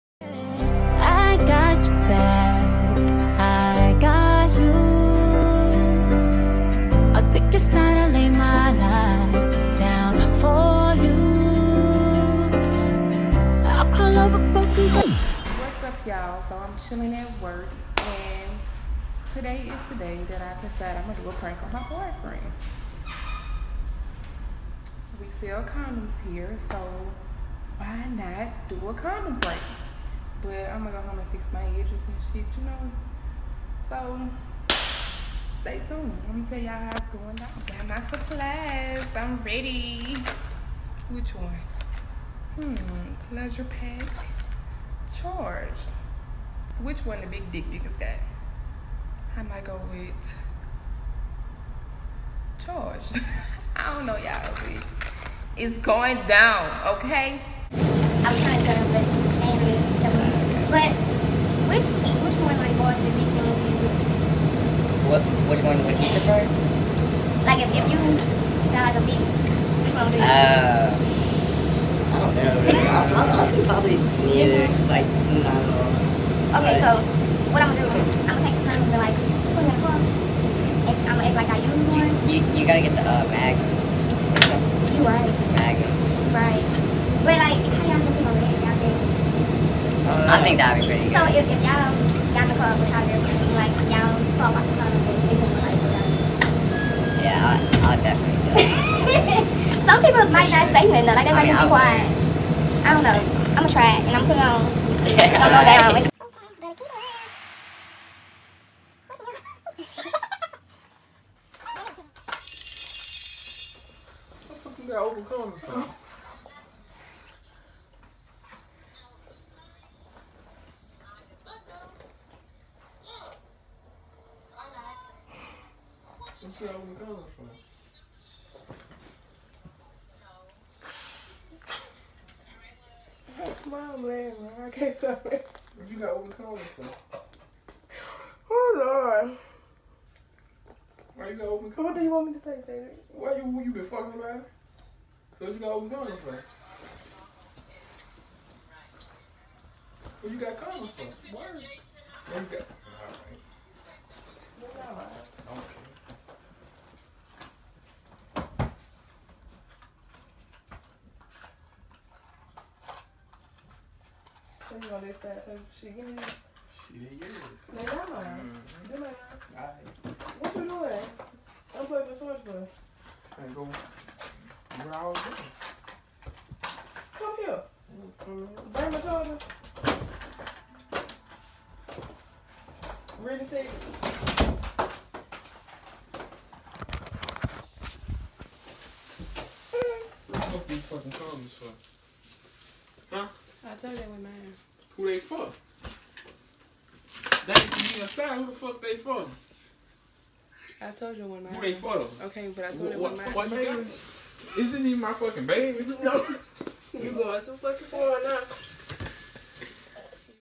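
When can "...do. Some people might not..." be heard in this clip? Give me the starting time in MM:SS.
01:38.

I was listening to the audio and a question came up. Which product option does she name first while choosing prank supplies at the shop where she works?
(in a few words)
Pleasure pack.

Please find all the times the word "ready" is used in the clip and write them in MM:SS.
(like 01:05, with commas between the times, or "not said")
00:39, 03:03.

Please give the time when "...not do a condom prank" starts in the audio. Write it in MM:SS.
00:28.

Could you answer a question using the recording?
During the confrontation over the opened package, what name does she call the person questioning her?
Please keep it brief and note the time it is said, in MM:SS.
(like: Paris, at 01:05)
Cedric, at 02:22.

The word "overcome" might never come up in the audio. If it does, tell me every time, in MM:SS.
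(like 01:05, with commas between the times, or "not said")
01:55, 02:16.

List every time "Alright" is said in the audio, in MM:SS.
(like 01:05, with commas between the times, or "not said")
02:49.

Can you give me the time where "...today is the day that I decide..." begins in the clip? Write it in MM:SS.
00:19.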